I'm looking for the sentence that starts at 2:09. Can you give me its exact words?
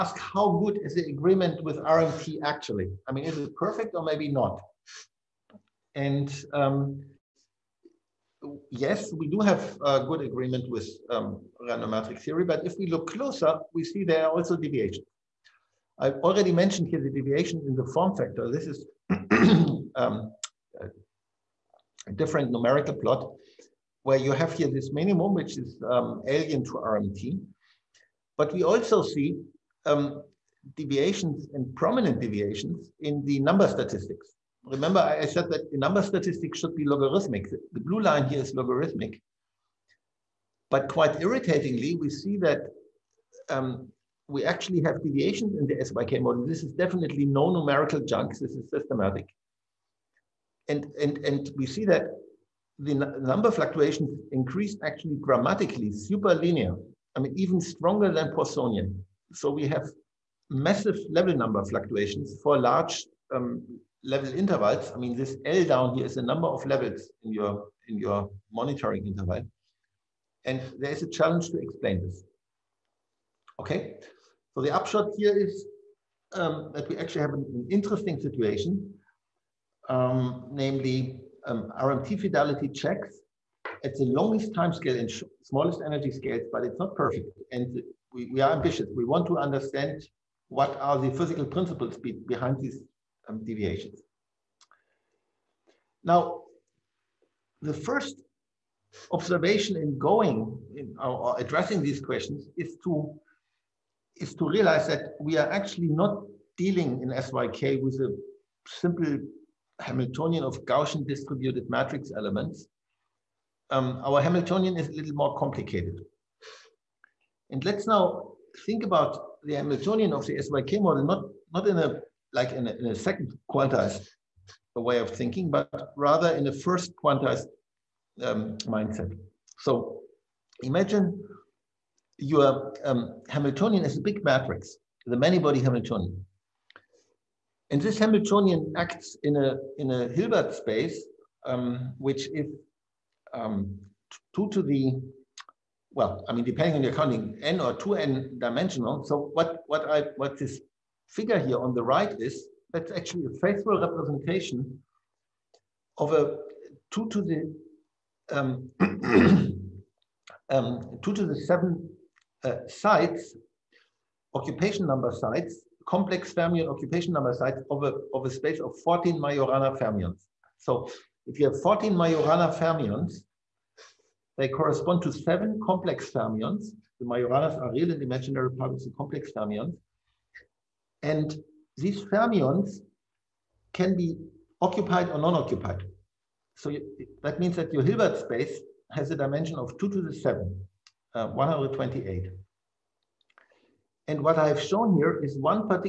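So imagine your um, Hamiltonian is a big matrix, the many-body Hamiltonian.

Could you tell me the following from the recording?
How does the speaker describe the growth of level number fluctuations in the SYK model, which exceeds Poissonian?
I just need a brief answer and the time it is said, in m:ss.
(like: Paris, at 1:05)
Super linear, at 0:55.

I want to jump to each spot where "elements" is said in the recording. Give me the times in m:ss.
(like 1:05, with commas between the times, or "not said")
1:52.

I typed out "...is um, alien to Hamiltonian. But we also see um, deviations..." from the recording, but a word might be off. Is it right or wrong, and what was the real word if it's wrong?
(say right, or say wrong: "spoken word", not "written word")
wrong: "RMT", not "Hamiltonian".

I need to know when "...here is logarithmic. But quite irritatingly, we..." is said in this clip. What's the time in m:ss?
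0:38.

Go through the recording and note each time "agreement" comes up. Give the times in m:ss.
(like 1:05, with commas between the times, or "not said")
0:01, 0:10.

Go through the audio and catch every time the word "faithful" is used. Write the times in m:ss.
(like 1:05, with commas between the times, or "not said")
2:33.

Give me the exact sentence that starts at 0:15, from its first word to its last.
I've already mentioned here the deviation in the form factor.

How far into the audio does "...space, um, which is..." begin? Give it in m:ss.
2:20.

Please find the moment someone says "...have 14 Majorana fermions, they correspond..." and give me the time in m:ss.
2:51.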